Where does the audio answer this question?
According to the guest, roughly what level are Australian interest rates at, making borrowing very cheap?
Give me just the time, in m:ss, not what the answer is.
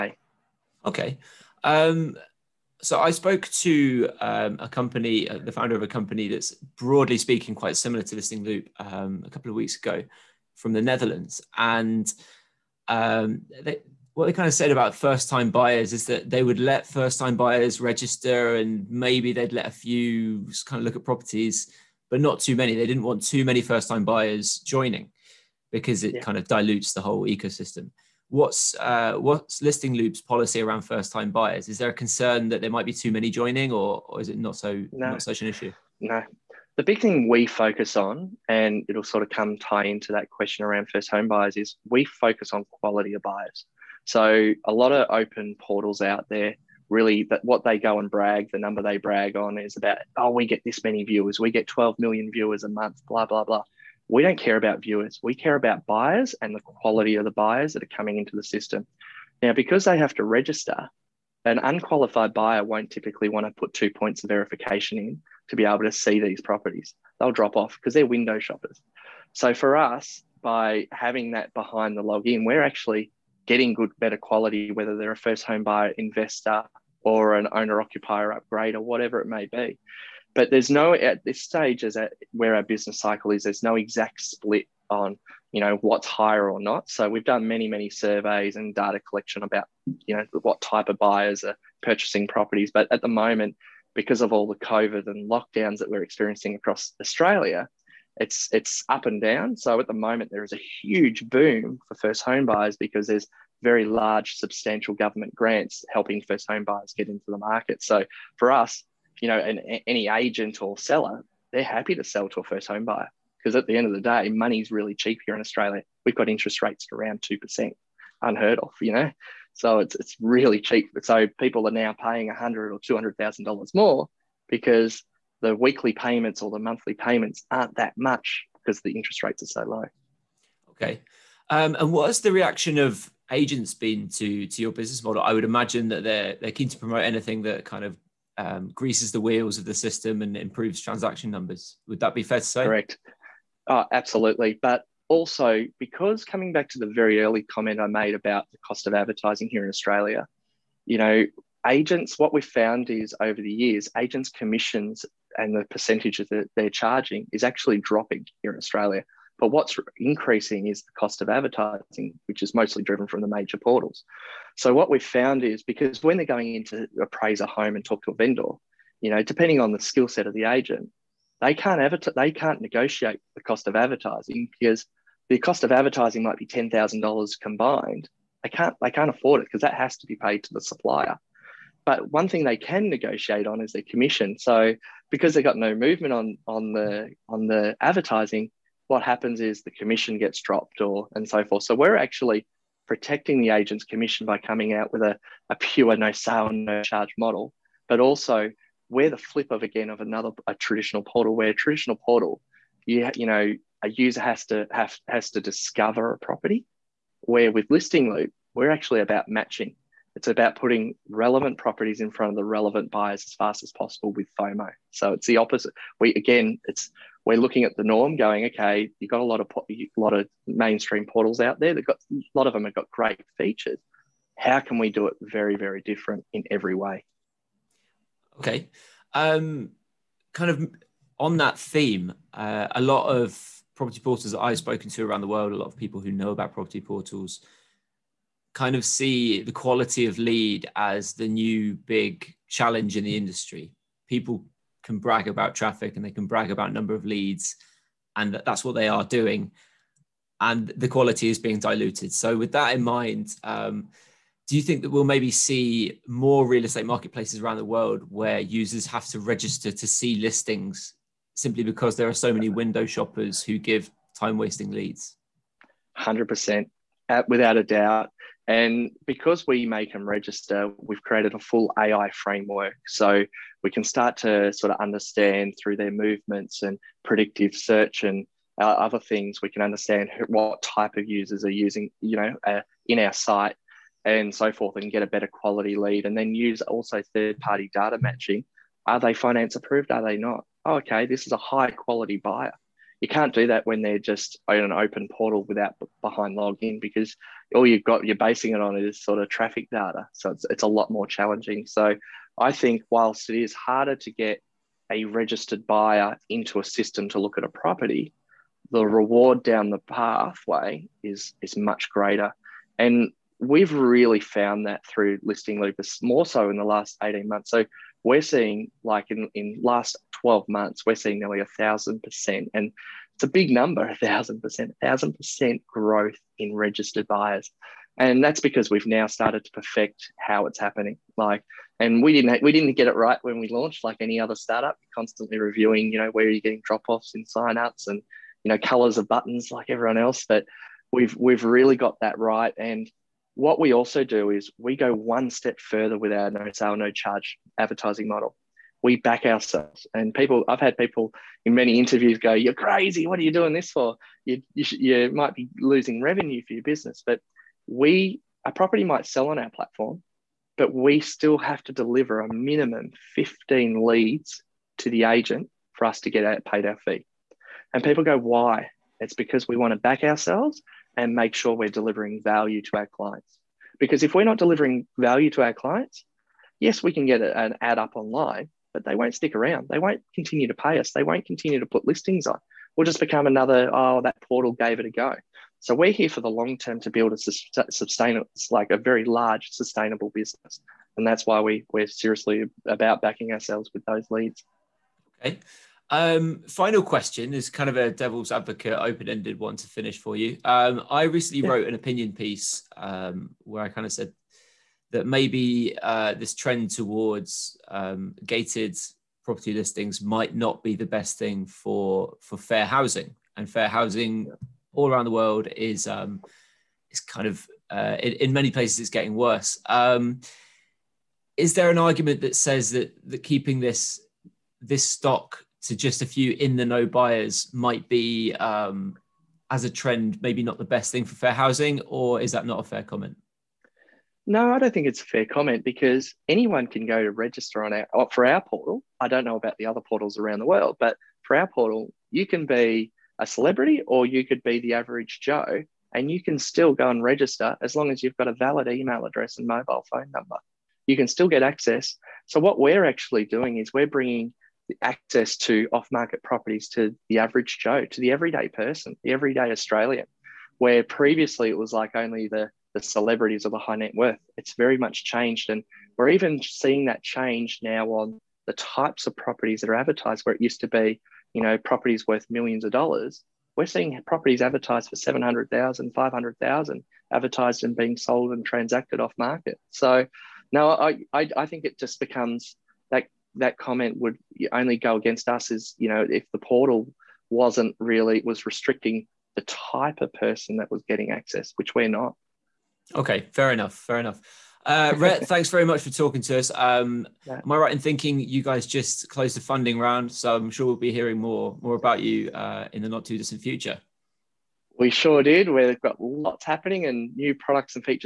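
1:57.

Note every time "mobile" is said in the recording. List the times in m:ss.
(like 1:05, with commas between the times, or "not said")
7:29.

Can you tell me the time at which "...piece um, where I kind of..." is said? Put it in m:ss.
6:42.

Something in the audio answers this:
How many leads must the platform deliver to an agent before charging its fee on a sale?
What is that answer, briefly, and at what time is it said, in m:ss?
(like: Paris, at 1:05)
15, at 6:03.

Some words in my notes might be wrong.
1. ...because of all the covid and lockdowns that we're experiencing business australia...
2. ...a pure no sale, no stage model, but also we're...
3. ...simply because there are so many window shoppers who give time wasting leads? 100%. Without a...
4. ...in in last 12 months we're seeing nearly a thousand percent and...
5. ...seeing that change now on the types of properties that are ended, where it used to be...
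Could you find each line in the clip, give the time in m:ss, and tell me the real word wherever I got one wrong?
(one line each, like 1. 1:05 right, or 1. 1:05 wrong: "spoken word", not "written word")
1. 1:33 wrong: "across", not "business"
2. 3:15 wrong: "charge", not "stage"
3. 4:21 right
4. 5:19 right
5. 7:46 wrong: "advertised", not "ended".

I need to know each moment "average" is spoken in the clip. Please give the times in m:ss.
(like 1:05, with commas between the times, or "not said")
7:24, 7:37.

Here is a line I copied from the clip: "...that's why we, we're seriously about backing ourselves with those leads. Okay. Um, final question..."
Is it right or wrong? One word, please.
right.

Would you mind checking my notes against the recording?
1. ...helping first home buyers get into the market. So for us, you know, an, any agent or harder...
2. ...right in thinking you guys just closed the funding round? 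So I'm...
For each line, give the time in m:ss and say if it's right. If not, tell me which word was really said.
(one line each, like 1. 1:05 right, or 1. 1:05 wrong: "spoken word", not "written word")
1. 1:45 wrong: "seller", not "harder"
2. 8:17 right.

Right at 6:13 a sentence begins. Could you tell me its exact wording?
Because if we're not delivering value to our clients, yes, we can get an ad up online, but they won't stick around.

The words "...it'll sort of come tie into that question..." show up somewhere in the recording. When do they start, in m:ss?
0:38.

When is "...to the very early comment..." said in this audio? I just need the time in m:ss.
2:26.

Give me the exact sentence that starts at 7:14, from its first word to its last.
No, I don't think it's a fair comment because anyone can go to register on our for our portal.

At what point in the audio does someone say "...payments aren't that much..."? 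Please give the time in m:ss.
2:06.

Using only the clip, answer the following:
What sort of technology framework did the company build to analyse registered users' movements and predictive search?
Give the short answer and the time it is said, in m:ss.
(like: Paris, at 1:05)
AI, at 4:31.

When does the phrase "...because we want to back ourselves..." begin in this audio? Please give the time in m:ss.
6:09.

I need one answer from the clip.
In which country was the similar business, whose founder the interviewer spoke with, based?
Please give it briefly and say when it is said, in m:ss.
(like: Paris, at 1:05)
the Netherlands, at 0:10.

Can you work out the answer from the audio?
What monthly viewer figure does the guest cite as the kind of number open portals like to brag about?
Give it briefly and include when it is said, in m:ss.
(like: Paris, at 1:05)
12 million, at 0:51.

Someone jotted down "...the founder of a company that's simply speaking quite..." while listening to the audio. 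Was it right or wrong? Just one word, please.
wrong.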